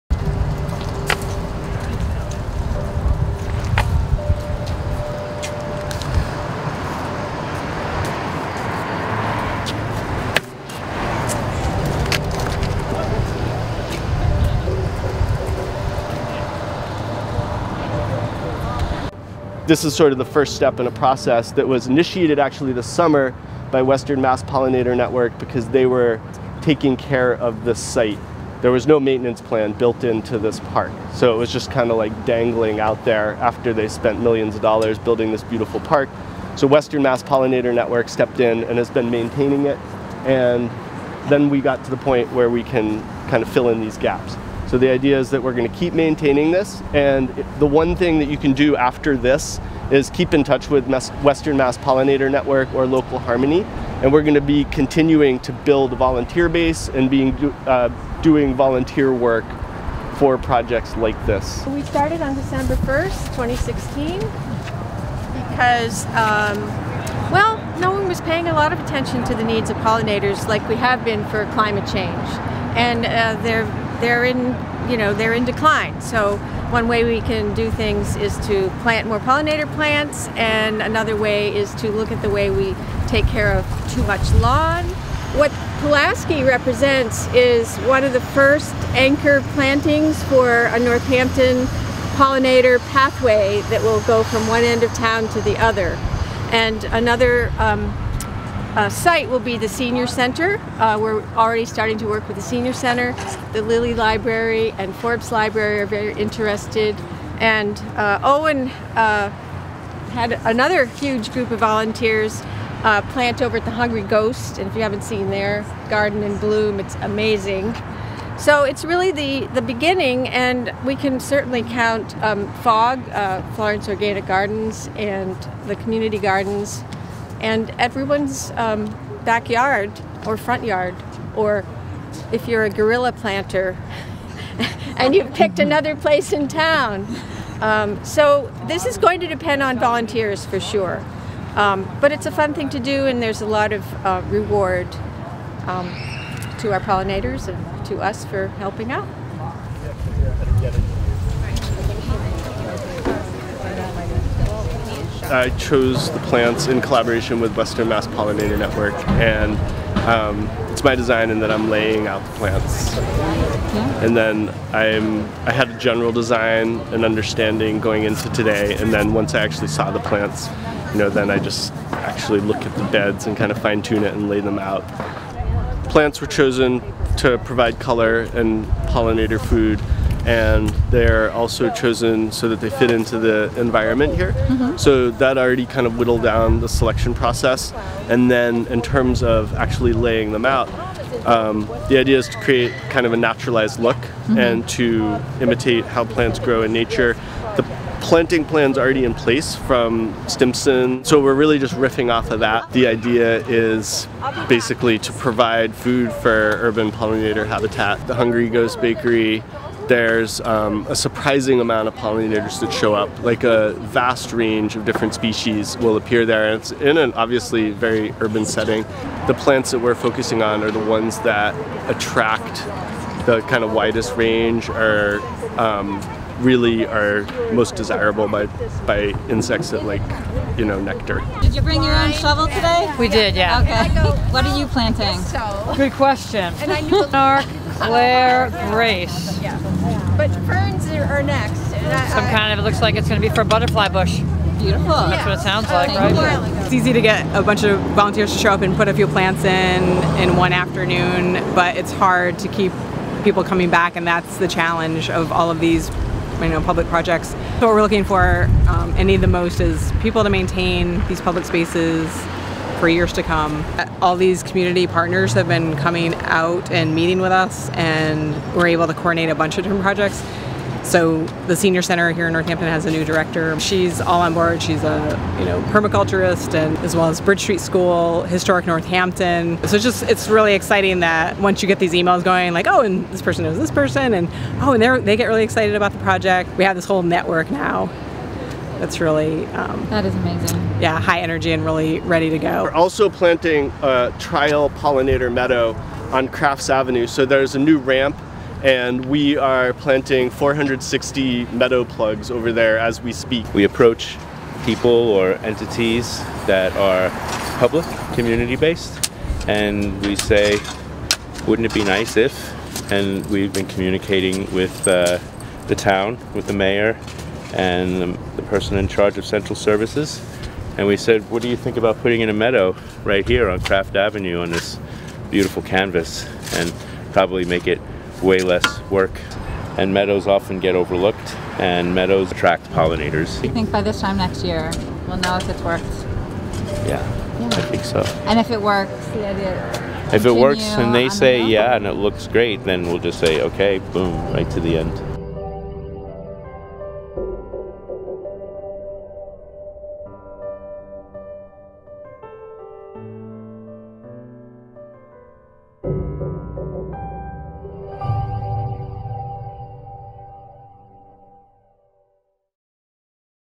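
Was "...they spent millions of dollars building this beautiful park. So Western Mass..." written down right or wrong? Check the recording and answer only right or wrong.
right.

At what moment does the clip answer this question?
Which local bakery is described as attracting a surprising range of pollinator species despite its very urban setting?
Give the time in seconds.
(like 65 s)
208 s.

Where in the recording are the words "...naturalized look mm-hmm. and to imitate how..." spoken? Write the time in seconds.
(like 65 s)
193 s.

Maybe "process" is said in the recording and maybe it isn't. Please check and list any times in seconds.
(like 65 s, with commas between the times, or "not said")
20 s, 187 s.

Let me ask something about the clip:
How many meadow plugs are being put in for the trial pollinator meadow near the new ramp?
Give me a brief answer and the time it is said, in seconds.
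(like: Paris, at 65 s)
460, at 300 s.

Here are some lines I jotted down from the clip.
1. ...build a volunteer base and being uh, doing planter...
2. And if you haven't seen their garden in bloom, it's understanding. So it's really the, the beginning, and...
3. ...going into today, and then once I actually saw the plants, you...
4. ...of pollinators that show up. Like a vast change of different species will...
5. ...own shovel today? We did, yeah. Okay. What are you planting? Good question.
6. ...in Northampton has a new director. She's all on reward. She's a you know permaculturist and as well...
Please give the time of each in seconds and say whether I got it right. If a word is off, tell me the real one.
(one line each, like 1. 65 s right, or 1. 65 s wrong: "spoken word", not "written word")
1. 55 s wrong: "volunteer", not "planter"
2. 114 s wrong: "amazing", not "understanding"
3. 167 s right
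4. 211 s wrong: "range", not "change"
5. 231 s right
6. 272 s wrong: "board", not "reward".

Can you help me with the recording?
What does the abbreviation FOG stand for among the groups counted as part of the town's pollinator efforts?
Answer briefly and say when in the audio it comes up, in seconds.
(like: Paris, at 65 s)
Florence Organic Gardens, at 123 s.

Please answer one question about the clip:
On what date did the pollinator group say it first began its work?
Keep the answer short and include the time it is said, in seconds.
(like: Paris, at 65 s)
December 1st, 2016, at 62 s.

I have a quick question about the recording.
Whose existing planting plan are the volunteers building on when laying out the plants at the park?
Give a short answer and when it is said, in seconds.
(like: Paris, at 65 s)
Stimson, at 200 s.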